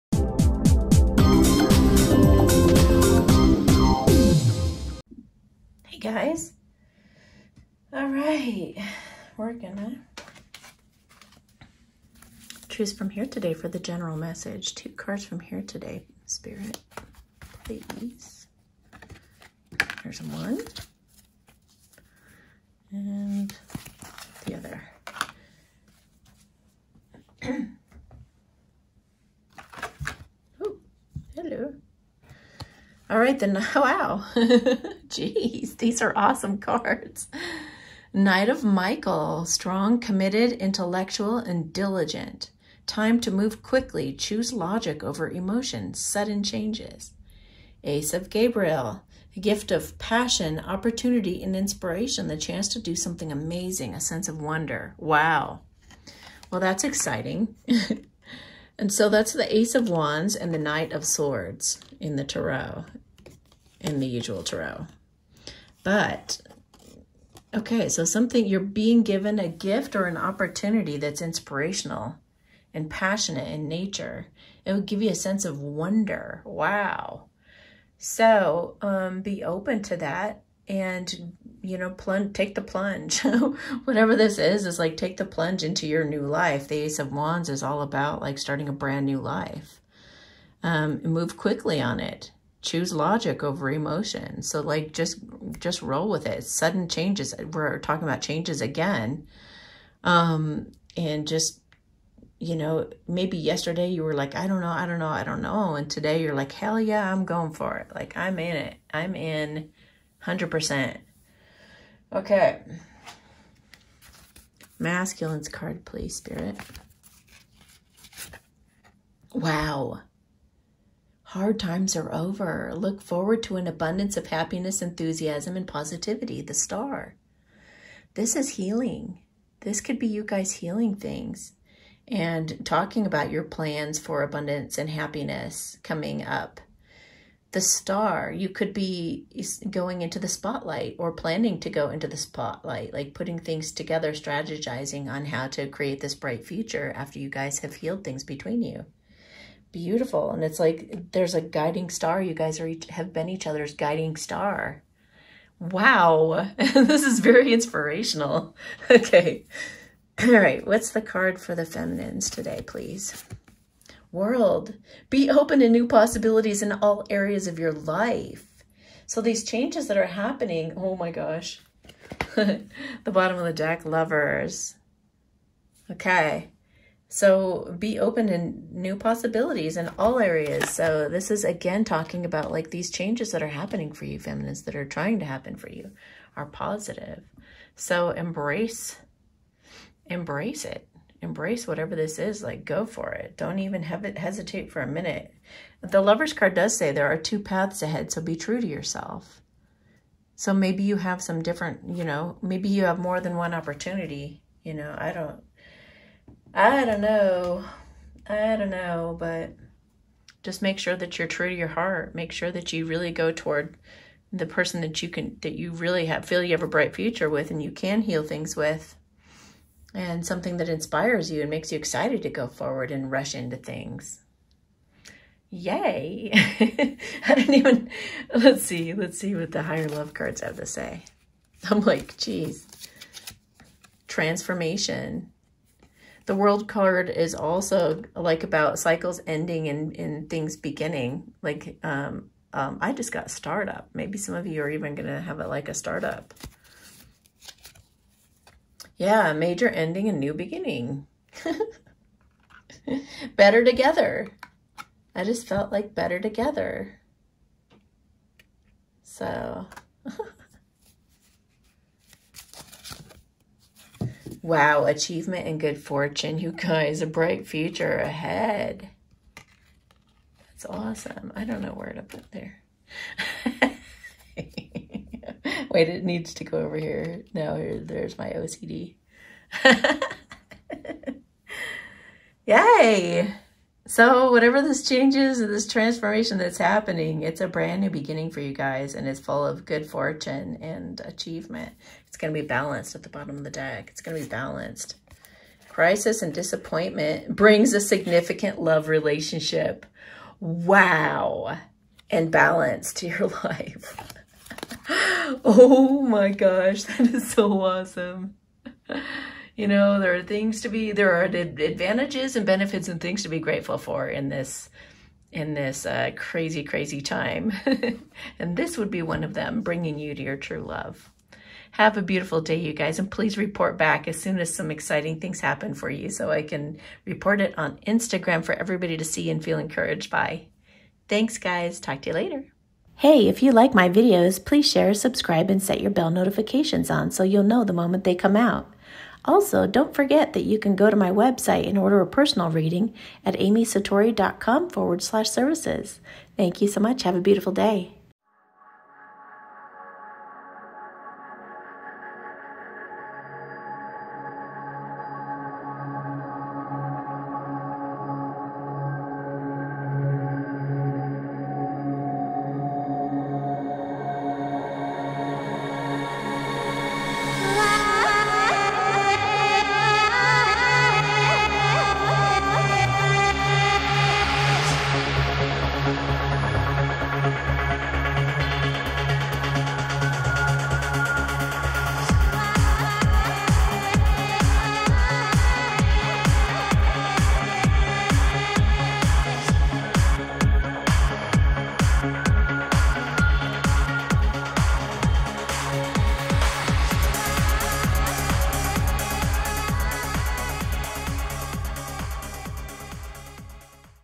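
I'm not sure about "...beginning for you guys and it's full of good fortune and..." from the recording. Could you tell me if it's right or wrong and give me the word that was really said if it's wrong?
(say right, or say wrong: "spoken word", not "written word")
right.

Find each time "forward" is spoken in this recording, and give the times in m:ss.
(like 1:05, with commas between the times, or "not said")
2:03, 3:42, 5:44.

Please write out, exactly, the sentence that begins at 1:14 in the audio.
It would give you a sense of wonder.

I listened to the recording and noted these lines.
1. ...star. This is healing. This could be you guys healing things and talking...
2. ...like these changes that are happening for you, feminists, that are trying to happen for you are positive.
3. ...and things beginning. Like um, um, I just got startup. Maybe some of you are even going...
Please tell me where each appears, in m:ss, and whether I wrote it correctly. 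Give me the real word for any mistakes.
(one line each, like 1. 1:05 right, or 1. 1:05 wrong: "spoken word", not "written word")
1. 2:06 right
2. 3:02 right
3. 3:59 right.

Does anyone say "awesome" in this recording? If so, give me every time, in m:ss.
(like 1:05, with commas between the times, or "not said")
0:36, 4:30, 5:07.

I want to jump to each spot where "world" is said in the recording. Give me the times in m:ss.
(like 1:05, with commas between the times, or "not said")
2:44, 3:56.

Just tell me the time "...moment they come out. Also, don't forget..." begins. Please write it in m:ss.
5:37.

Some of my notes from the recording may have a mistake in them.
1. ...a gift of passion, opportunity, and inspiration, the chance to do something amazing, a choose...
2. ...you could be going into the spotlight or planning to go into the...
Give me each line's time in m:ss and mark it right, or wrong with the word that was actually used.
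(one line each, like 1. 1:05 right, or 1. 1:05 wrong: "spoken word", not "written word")
1. 0:49 wrong: "sense", not "choose"
2. 2:18 right.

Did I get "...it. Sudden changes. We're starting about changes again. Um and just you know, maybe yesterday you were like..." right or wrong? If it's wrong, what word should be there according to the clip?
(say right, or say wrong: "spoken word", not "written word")
wrong: "talking", not "starting".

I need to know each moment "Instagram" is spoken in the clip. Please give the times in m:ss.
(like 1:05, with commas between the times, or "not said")
5:27.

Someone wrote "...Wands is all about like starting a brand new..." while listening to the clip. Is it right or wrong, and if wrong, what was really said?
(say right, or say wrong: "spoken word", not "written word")
right.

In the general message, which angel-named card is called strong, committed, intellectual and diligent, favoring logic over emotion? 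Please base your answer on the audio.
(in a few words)
Knight of Michael.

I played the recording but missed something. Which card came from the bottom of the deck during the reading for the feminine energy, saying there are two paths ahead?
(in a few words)
Lovers.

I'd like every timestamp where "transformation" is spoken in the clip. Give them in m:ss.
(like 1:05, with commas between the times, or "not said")
3:54, 4:45.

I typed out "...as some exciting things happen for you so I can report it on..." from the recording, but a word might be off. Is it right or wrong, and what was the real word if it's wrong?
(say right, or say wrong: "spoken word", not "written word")
right.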